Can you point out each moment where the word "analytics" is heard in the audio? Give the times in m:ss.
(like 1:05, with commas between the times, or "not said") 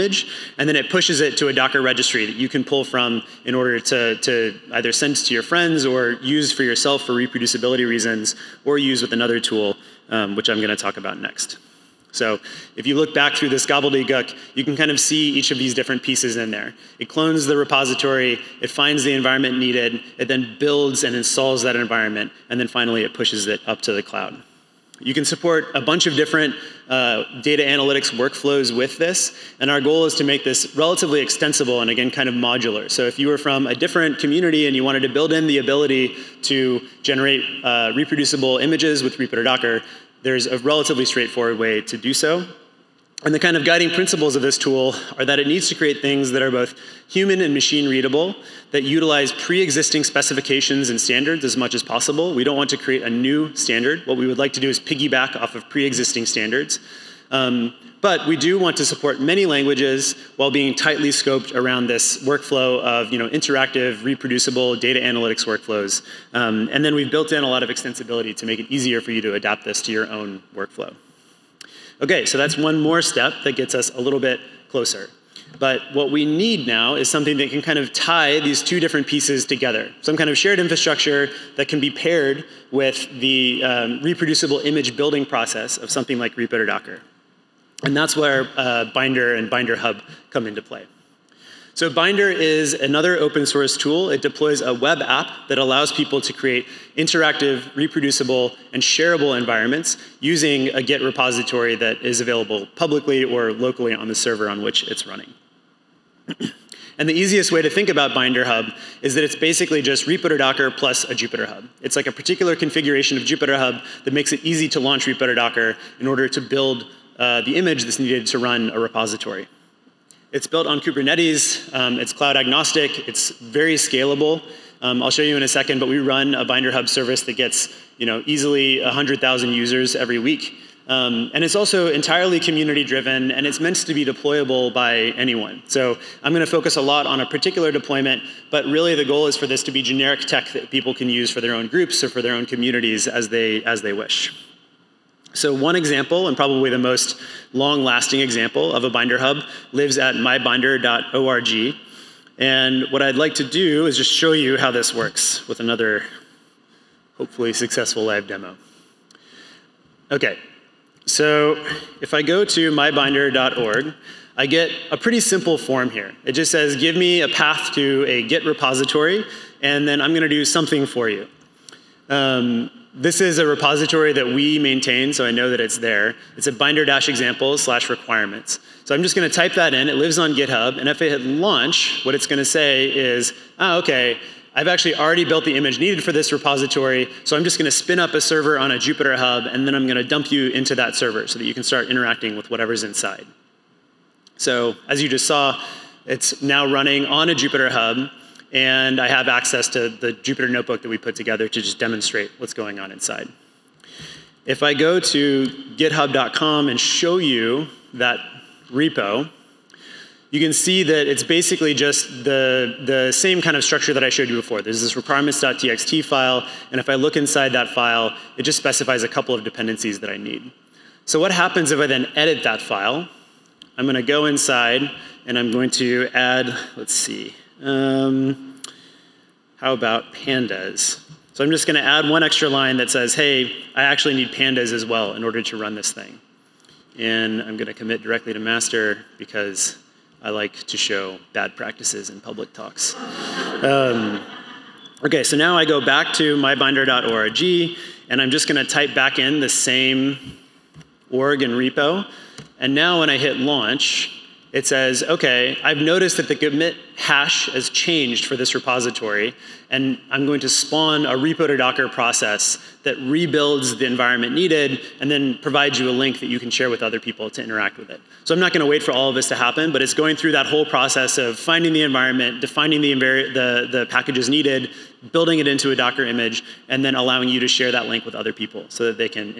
0:27, 1:05.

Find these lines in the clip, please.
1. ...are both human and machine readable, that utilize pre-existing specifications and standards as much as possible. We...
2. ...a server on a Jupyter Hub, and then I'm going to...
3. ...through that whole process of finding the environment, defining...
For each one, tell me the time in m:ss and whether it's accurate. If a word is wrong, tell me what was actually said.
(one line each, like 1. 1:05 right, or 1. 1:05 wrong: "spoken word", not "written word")
1. 0:46 right
2. 3:08 right
3. 4:30 right.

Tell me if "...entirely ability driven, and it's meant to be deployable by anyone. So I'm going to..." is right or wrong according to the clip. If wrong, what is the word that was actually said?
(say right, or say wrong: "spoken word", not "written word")
wrong: "community", not "ability".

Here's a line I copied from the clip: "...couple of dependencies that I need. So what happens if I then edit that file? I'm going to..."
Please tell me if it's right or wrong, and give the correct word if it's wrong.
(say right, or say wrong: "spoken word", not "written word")
right.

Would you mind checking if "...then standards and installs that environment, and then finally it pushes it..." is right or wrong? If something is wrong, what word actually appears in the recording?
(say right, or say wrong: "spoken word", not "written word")
wrong: "builds", not "standards".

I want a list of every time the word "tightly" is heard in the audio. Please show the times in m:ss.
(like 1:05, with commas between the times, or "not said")
1:00.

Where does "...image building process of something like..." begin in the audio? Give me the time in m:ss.
1:24.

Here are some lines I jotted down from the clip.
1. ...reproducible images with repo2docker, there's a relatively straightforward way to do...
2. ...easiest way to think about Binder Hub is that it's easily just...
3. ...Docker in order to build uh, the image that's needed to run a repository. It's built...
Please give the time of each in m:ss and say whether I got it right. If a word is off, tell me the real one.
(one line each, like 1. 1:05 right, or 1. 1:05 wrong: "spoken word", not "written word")
1. 0:37 right
2. 1:47 wrong: "basically", not "easily"
3. 1:55 right.